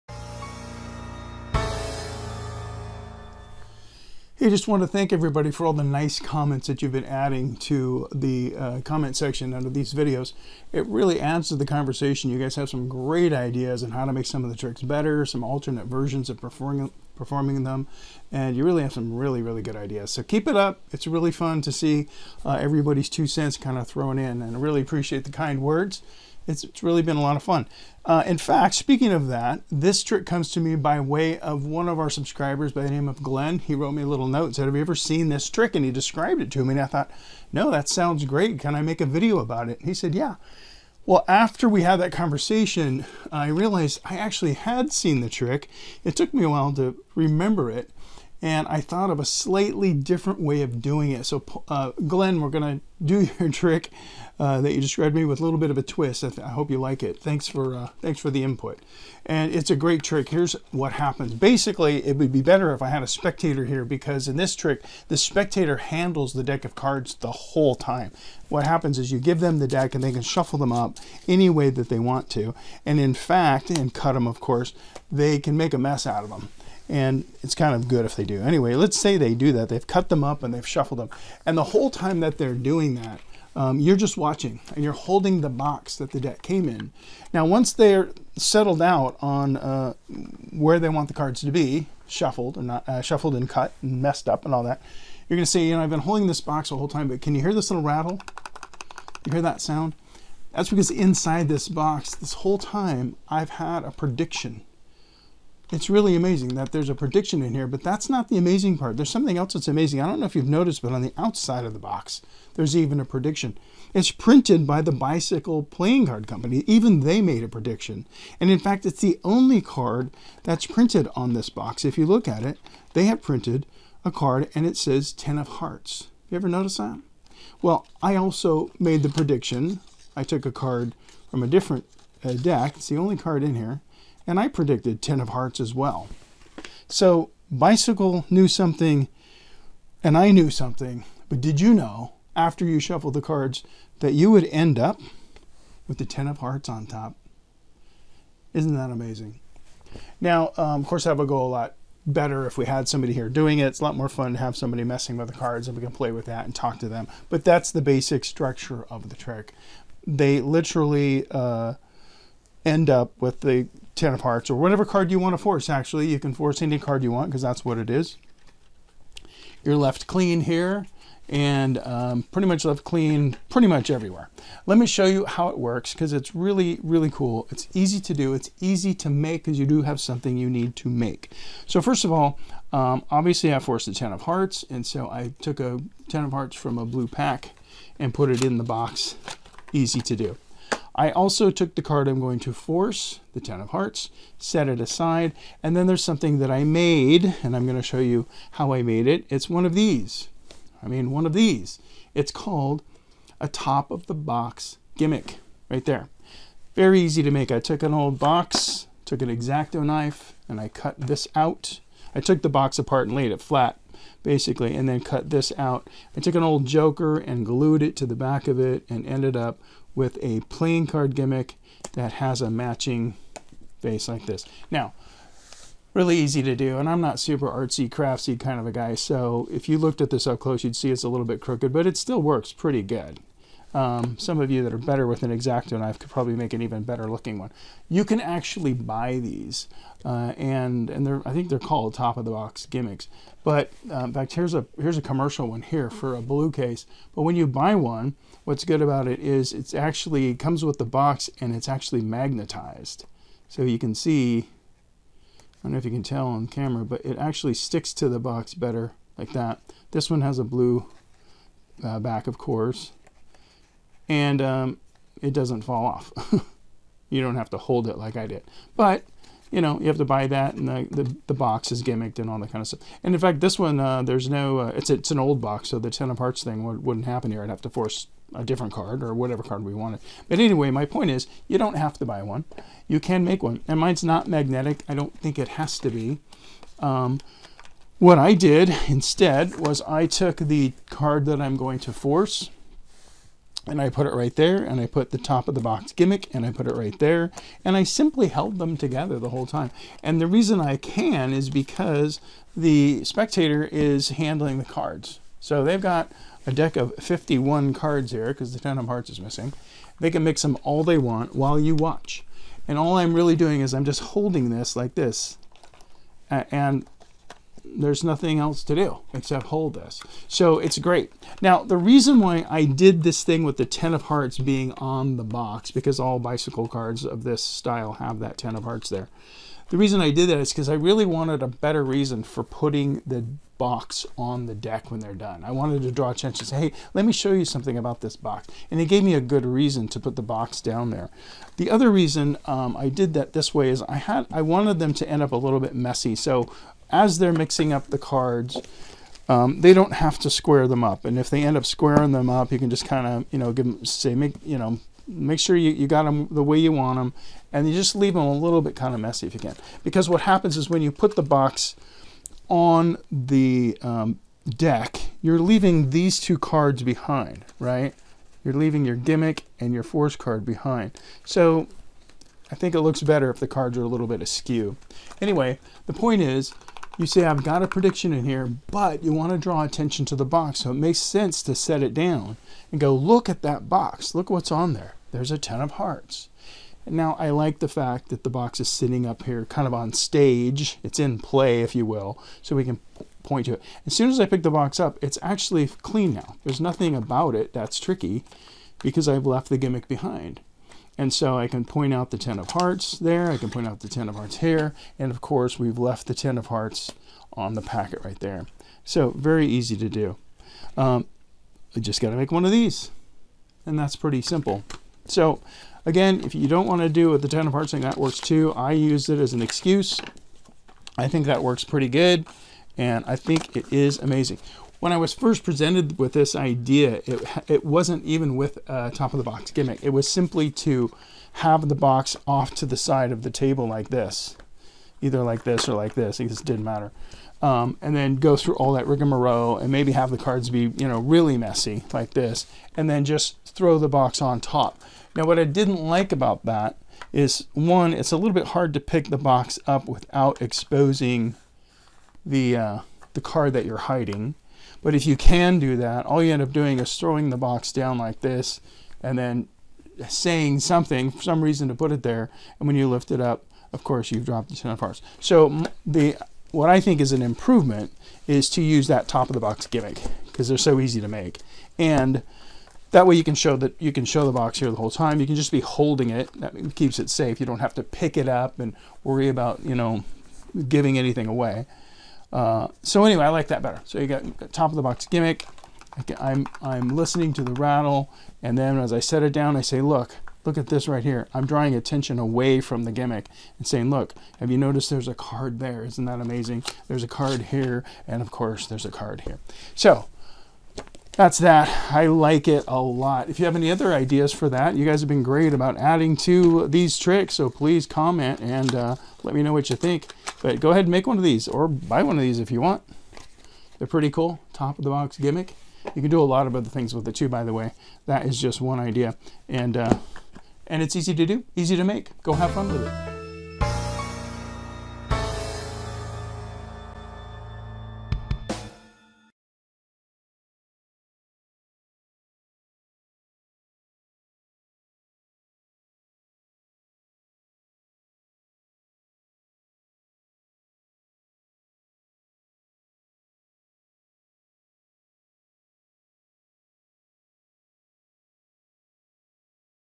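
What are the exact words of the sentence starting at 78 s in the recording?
Anyway, let's say they do that.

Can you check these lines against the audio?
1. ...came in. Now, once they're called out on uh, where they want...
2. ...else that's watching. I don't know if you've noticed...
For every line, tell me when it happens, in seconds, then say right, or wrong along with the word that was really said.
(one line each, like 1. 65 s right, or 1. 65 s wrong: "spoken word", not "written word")
1. 86 s wrong: "settled", not "called"
2. 109 s wrong: "amazing", not "watching".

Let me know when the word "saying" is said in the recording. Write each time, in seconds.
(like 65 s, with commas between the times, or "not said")
460 s, 493 s.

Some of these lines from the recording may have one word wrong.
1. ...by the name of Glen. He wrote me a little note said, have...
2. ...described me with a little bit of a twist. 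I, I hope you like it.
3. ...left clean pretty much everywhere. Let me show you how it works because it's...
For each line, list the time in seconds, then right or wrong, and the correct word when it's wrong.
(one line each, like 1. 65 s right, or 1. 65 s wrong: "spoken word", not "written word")
1. 32 s right
2. 54 s right
3. 172 s right.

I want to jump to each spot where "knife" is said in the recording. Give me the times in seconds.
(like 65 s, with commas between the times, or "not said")
209 s, 235 s.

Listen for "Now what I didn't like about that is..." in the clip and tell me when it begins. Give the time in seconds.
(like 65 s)
445 s.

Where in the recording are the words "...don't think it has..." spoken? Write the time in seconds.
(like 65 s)
284 s.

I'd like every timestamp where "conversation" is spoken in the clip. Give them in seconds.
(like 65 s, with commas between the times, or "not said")
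11 s, 42 s.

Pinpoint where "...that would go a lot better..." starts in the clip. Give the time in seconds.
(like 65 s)
151 s.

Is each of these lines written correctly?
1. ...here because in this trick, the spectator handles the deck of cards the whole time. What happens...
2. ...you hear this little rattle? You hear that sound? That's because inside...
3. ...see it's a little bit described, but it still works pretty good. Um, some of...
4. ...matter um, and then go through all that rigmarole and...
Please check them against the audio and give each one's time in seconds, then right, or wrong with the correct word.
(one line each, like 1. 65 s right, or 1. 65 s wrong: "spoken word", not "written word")
1. 63 s right
2. 97 s right
3. 230 s wrong: "crooked", not "described"
4. 436 s right.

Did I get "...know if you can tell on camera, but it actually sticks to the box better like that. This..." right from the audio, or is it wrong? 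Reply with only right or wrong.
right.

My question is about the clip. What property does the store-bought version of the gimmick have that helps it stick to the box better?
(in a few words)
Magnetized.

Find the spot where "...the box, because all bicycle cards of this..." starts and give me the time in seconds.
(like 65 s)
325 s.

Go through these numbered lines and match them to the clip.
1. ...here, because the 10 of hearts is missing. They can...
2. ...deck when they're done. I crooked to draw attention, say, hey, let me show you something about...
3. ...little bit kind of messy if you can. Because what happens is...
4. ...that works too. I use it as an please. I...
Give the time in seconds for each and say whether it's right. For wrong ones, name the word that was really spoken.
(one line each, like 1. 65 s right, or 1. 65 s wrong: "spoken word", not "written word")
1. 308 s right
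2. 334 s wrong: "wanted", not "crooked"
3. 358 s right
4. 417 s wrong: "excuse", not "please".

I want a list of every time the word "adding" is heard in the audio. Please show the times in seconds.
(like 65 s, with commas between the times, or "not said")
7 s, 505 s.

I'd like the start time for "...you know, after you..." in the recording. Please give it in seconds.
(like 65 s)
141 s.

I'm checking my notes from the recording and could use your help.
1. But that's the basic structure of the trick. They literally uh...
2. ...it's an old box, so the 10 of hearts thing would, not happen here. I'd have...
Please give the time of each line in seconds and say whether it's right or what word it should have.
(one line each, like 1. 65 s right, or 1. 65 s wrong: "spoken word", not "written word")
1. 157 s right
2. 274 s right.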